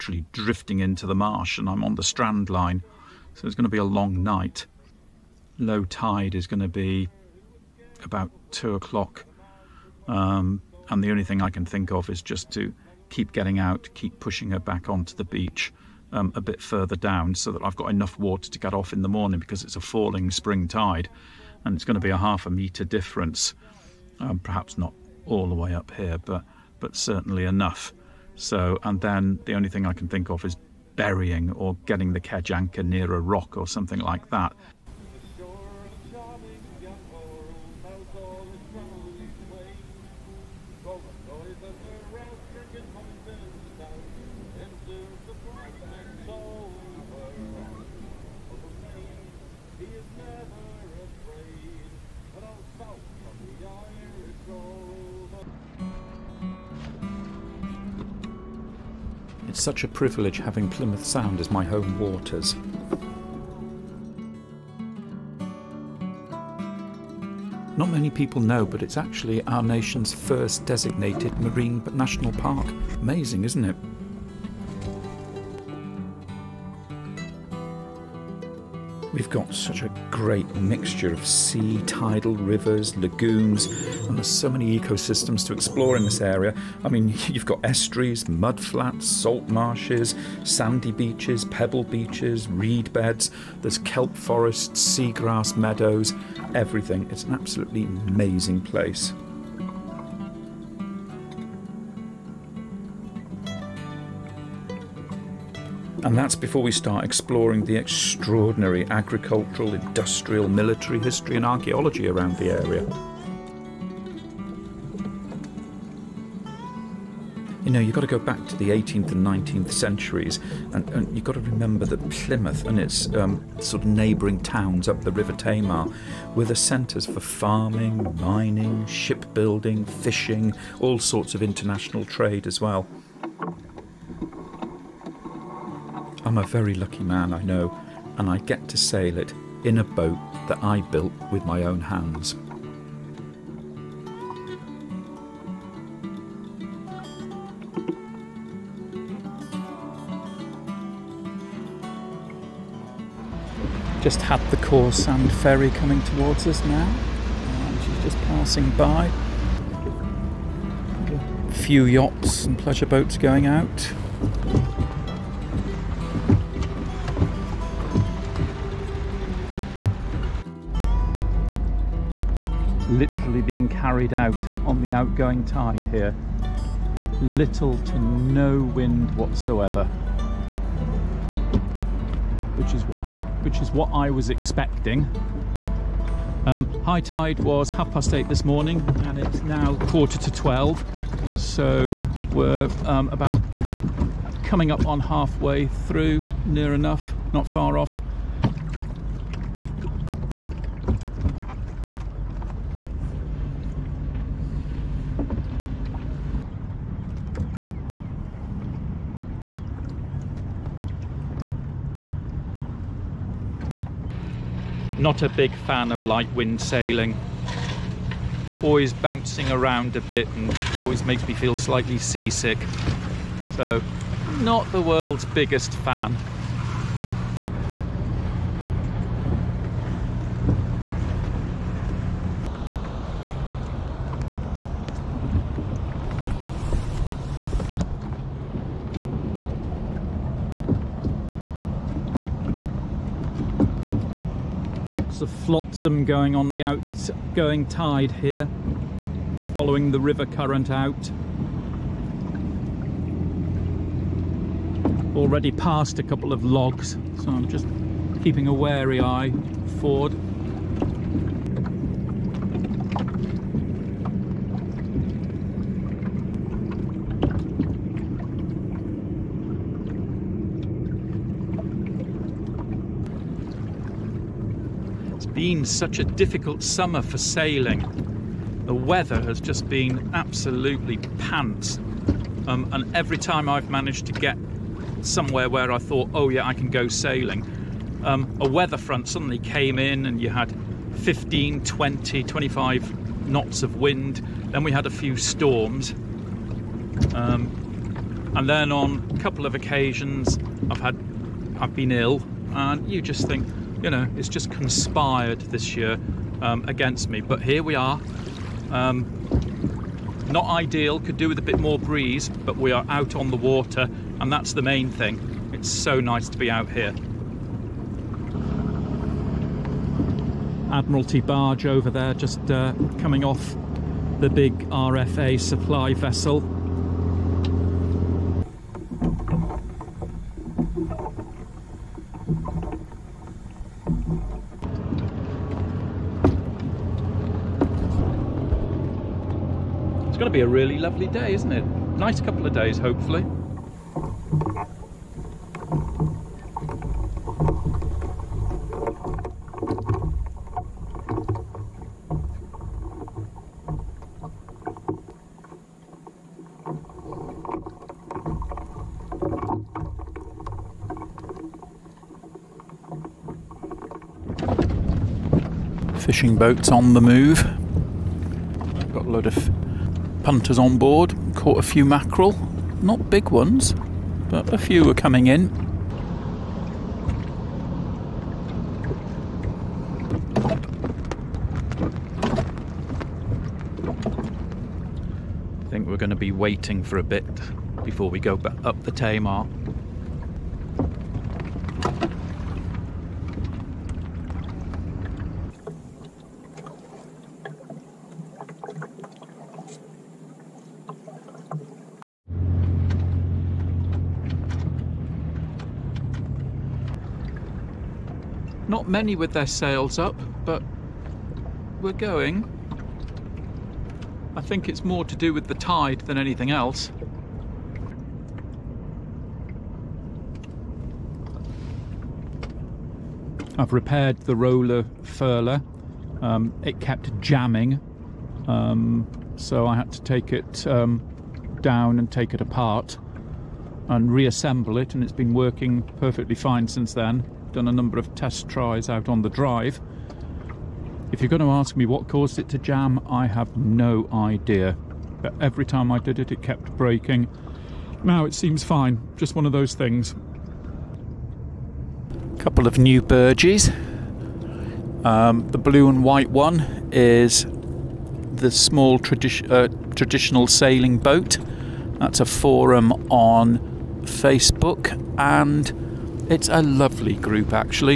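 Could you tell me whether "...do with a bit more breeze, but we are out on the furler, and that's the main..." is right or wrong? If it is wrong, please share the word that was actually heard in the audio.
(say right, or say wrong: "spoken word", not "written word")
wrong: "water", not "furler".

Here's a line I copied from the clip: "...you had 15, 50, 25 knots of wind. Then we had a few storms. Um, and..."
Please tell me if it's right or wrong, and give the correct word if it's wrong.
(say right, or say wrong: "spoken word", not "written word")
wrong: "20", not "50".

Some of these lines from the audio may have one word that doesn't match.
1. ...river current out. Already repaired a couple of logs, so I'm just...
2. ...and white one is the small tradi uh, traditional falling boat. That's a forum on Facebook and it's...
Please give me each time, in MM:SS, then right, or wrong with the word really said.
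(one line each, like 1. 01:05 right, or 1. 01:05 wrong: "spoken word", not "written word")
1. 04:09 wrong: "passed", not "repaired"
2. 07:35 wrong: "sailing", not "falling".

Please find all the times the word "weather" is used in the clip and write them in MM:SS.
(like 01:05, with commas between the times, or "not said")
04:38, 04:48.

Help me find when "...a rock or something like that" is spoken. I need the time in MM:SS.
00:33.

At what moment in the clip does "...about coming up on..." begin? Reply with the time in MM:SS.
03:13.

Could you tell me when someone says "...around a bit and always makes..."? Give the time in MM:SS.
03:39.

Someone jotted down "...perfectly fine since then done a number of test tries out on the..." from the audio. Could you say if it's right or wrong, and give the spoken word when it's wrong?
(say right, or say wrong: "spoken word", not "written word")
right.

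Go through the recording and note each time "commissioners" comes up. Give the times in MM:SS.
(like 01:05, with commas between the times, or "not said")
not said.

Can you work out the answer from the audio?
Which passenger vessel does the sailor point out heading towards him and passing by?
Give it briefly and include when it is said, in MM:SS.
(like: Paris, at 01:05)
Cawsand ferry, at 02:34.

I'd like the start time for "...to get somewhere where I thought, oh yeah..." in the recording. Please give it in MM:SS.
04:44.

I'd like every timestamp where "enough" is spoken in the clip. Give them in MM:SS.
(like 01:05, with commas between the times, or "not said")
00:17, 00:27, 03:16.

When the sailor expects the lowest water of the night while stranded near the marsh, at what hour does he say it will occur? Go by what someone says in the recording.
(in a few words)
2 o'clock.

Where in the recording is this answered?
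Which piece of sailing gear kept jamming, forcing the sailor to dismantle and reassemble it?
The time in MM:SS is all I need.
07:04.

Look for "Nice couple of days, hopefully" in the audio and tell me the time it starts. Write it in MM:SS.
05:41.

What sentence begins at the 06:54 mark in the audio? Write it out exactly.
I think it's more to do with the tide than anything else.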